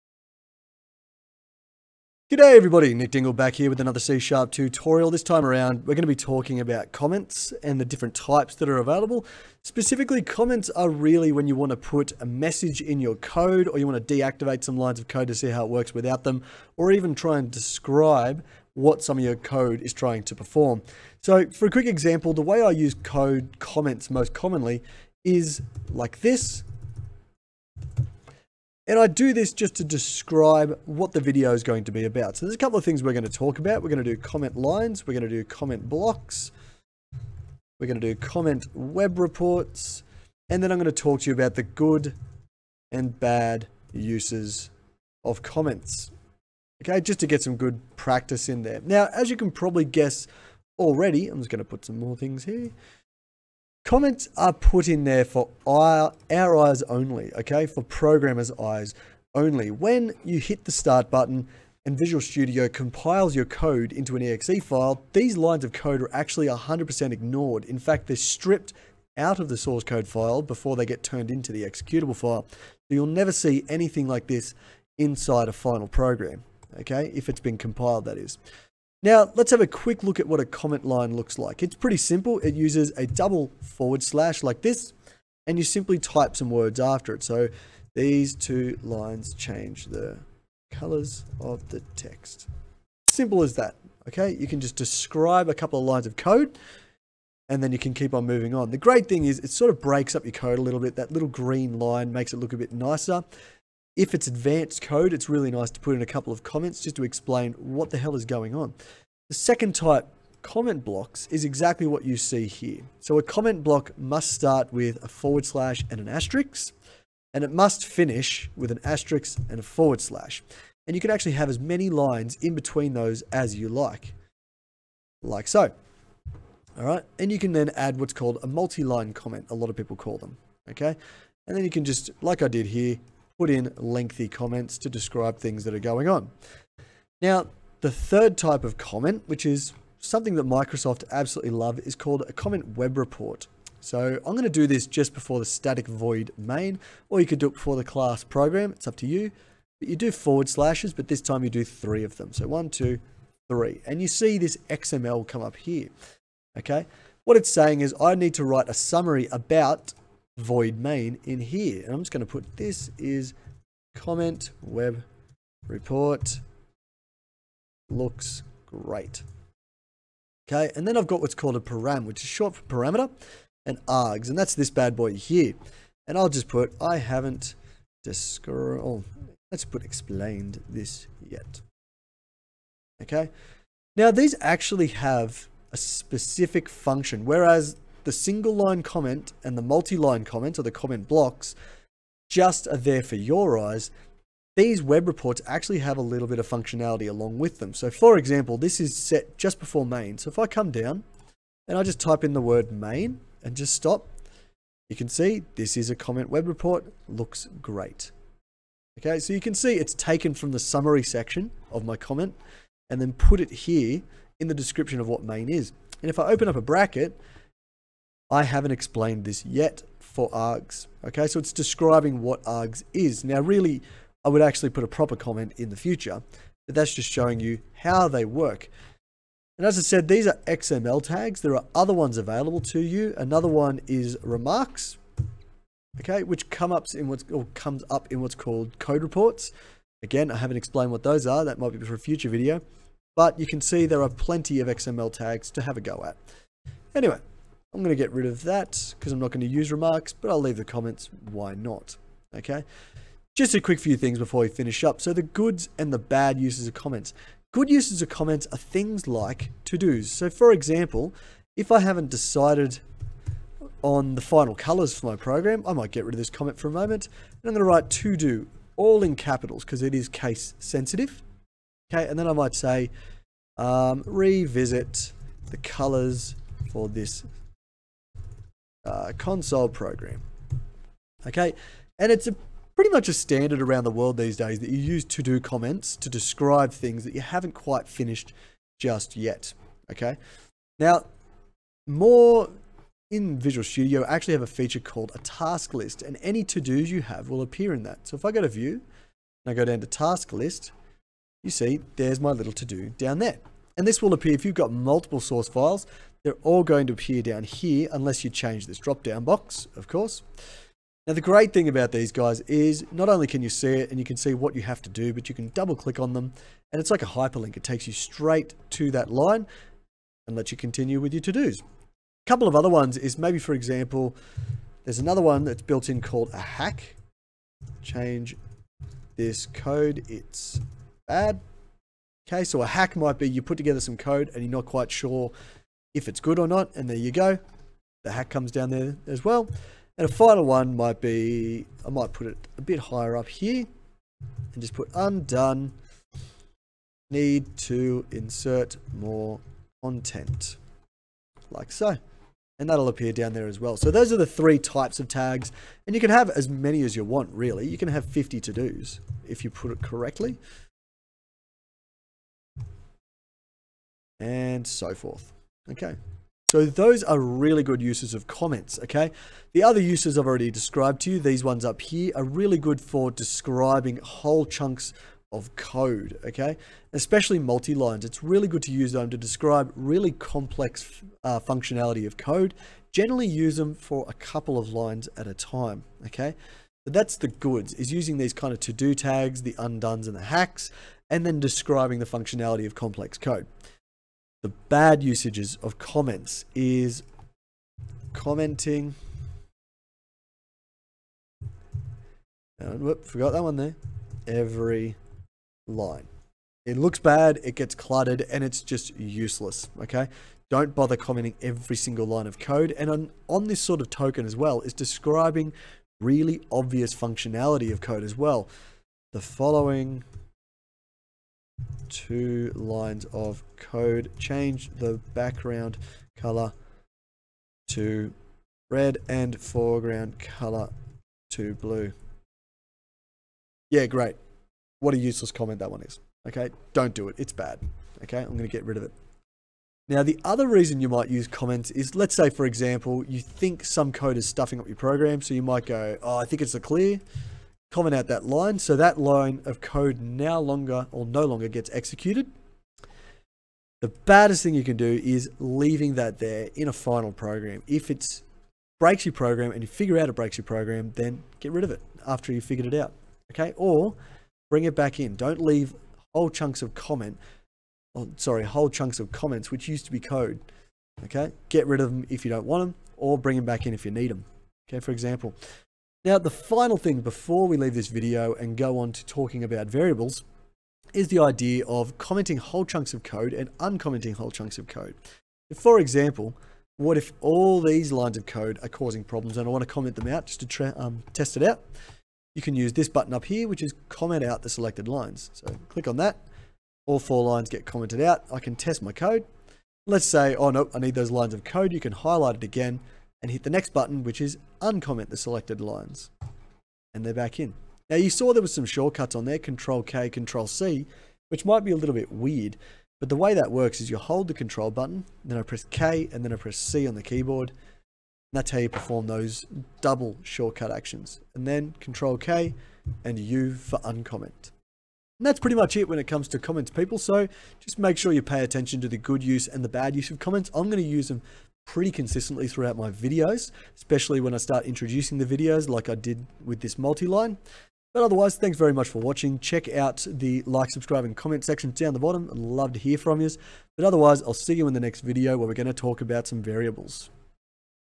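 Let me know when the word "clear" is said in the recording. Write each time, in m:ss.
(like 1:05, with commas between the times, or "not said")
7:26.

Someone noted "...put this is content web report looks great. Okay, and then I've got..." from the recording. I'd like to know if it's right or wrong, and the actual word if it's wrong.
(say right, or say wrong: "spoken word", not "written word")
wrong: "comment", not "content".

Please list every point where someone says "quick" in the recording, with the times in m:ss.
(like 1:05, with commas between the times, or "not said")
0:21, 1:19, 4:13.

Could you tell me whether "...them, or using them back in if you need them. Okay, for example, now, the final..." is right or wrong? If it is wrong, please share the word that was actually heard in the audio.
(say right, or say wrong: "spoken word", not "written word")
wrong: "bring", not "using".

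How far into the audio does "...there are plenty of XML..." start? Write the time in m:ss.
4:03.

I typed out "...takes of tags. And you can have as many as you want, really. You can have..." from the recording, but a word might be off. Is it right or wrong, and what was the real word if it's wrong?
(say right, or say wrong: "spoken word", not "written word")
wrong: "types", not "takes".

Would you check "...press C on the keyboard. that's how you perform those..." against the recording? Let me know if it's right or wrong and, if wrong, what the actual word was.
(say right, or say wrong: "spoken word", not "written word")
right.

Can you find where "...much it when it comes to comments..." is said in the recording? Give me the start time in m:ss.
8:45.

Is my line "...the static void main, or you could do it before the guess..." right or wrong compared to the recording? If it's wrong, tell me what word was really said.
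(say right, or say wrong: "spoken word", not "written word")
wrong: "class", not "guess".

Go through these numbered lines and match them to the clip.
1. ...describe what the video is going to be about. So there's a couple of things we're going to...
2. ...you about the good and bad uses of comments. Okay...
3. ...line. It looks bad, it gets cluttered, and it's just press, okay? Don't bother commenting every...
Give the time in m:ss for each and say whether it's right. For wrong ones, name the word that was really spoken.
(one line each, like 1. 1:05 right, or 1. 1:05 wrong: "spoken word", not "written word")
1. 0:29 right
2. 0:41 right
3. 6:45 wrong: "useless", not "press".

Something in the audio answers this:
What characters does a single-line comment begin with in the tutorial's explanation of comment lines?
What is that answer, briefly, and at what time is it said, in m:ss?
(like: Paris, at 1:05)
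Double forward slash, at 1:23.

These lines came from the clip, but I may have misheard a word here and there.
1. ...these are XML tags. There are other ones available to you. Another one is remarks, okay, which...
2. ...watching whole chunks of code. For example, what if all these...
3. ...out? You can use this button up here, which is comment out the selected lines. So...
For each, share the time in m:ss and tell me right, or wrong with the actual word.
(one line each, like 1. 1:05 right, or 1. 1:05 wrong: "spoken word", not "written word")
1. 3:50 right
2. 8:03 wrong: "uncommenting", not "watching"
3. 8:11 right.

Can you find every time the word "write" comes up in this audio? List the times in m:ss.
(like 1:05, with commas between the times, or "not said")
2:38, 4:27.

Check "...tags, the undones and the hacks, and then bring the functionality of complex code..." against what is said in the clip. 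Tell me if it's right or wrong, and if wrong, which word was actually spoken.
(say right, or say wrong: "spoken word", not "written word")
wrong: "describing", not "bring".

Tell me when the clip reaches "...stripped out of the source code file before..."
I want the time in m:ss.
1:08.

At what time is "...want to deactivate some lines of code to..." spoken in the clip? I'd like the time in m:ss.
0:13.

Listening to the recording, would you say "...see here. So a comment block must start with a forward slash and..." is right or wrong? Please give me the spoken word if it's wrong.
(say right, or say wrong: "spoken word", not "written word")
right.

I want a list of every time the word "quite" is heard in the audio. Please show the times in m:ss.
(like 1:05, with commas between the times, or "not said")
4:47, 5:34.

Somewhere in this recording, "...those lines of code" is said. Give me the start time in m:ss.
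8:20.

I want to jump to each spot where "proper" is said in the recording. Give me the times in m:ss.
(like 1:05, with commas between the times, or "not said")
3:44.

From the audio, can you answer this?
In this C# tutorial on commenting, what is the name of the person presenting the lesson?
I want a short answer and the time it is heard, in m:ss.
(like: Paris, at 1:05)
Nick Dingle, at 0:02.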